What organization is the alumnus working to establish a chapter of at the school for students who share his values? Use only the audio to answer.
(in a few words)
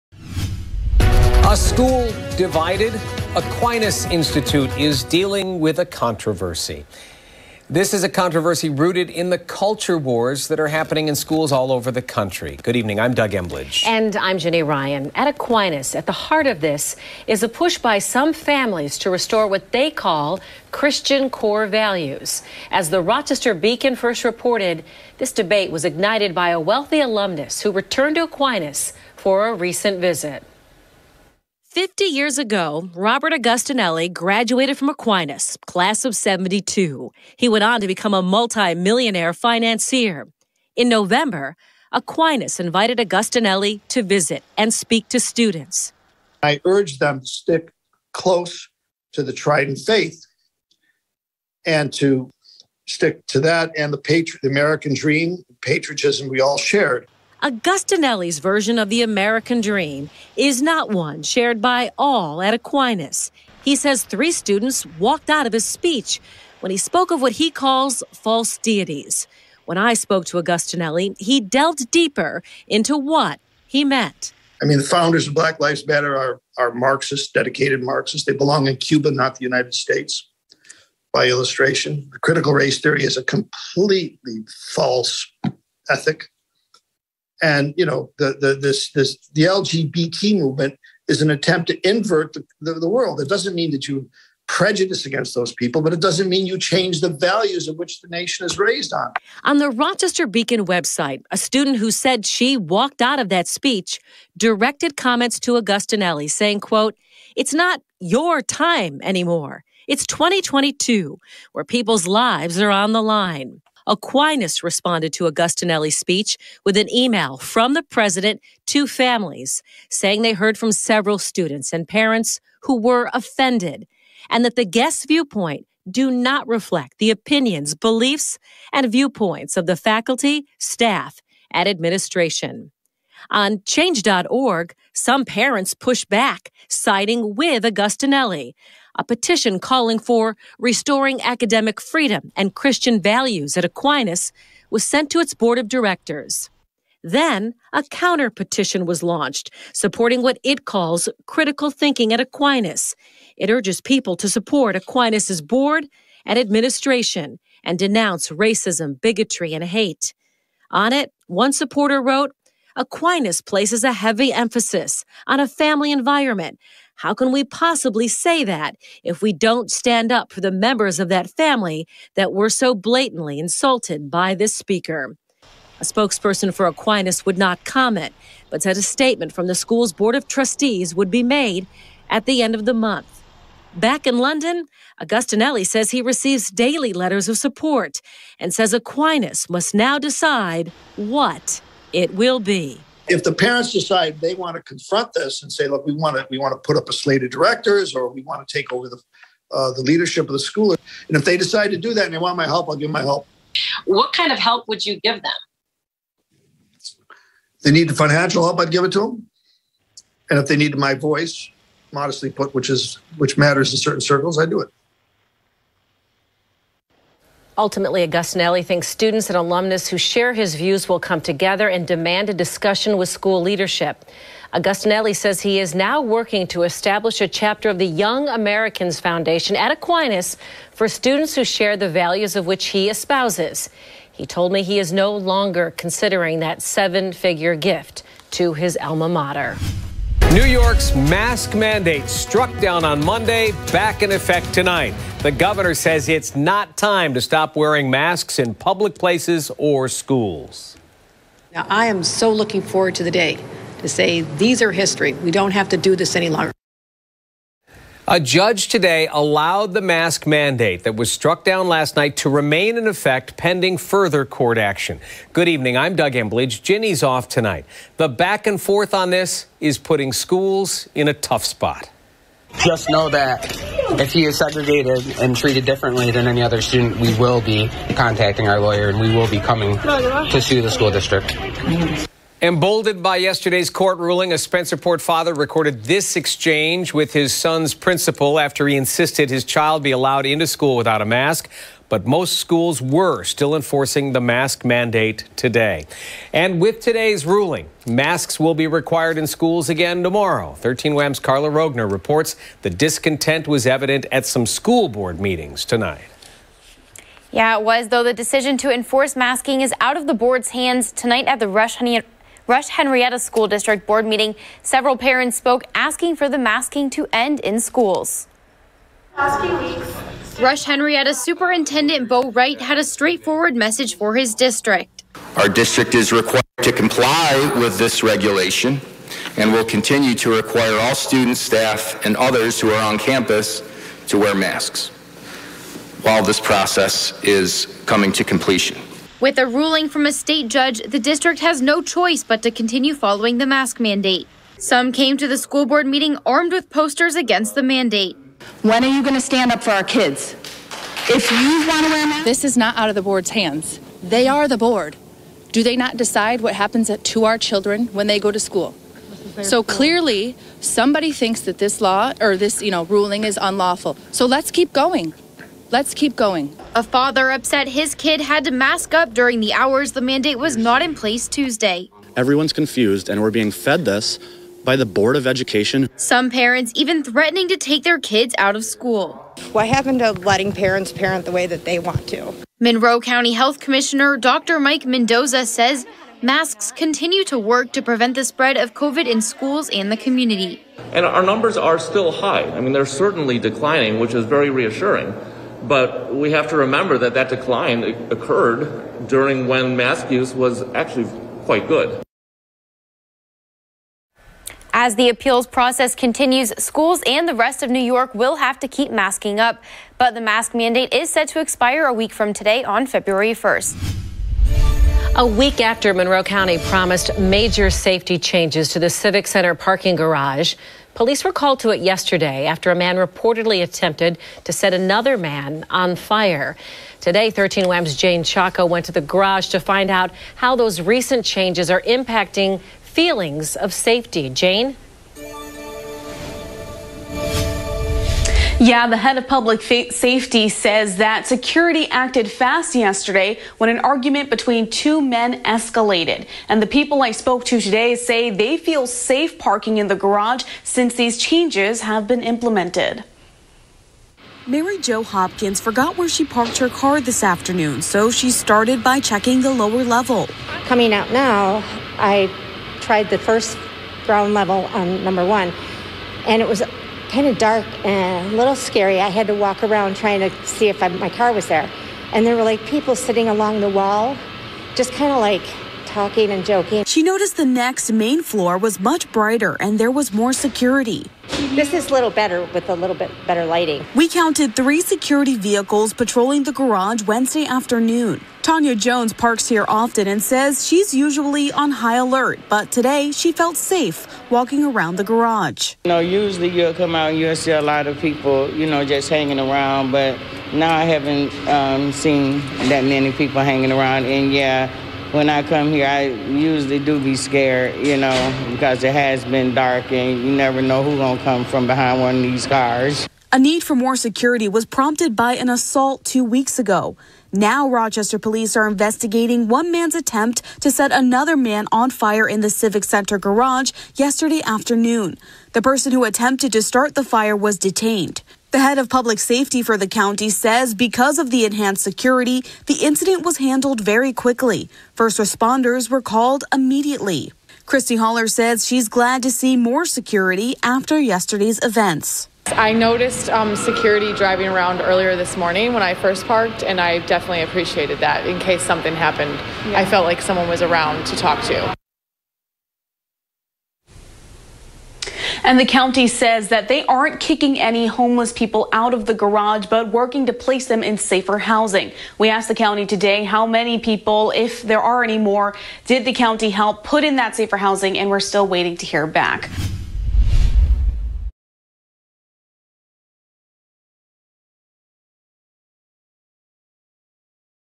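Young America's Foundation.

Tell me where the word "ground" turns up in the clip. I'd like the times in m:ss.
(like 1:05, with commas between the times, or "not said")
7:44.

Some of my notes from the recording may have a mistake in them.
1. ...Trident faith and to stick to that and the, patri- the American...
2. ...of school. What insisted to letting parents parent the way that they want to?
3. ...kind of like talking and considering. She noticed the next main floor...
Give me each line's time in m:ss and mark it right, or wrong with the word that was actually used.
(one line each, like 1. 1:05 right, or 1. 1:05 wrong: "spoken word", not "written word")
1. 0:49 right
2. 6:18 wrong: "happened", not "insisted"
3. 7:54 wrong: "joking", not "considering".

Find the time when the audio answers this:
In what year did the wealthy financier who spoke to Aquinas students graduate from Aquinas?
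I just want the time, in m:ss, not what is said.
0:35.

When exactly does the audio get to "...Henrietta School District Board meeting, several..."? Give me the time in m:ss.
5:12.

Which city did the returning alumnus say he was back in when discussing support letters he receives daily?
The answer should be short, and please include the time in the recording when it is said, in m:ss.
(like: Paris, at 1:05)
London, at 3:04.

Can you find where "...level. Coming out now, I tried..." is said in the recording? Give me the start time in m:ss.
7:39.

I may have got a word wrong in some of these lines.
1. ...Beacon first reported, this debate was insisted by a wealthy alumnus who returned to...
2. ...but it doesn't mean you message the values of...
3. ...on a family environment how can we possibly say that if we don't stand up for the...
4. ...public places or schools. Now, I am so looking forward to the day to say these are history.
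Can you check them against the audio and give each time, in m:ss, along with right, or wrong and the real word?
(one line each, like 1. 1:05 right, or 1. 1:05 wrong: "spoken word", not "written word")
1. 0:23 wrong: "ignited", not "insisted"
2. 1:35 wrong: "change", not "message"
3. 2:45 right
4. 4:08 right.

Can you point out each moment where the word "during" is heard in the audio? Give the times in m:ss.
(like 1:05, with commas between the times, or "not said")
6:09, 6:39.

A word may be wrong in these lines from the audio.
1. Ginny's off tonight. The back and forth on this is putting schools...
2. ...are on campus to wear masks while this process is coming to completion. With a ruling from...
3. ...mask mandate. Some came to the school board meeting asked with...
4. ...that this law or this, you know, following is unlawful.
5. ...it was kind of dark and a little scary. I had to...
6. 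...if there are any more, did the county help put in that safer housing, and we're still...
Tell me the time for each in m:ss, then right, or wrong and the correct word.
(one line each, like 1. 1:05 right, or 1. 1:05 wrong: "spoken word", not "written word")
1. 4:26 right
2. 5:32 right
3. 5:43 wrong: "armed", not "asked"
4. 6:01 wrong: "ruling", not "following"
5. 7:46 right
6. 9:24 right.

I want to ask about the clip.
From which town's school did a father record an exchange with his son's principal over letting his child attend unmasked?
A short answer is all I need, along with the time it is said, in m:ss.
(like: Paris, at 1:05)
Spencerport, at 4:44.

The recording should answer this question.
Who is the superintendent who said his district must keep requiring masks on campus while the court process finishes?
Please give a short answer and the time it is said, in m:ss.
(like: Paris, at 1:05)
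Bo Wright, at 5:22.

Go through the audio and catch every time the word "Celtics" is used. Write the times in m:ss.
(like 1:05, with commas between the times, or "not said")
not said.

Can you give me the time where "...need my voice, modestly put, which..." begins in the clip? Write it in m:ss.
3:30.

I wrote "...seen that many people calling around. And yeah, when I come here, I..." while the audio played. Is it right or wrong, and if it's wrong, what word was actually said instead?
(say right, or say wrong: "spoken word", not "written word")
wrong: "hanging", not "calling".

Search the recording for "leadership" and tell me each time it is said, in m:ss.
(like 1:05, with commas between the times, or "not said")
3:19, 3:43.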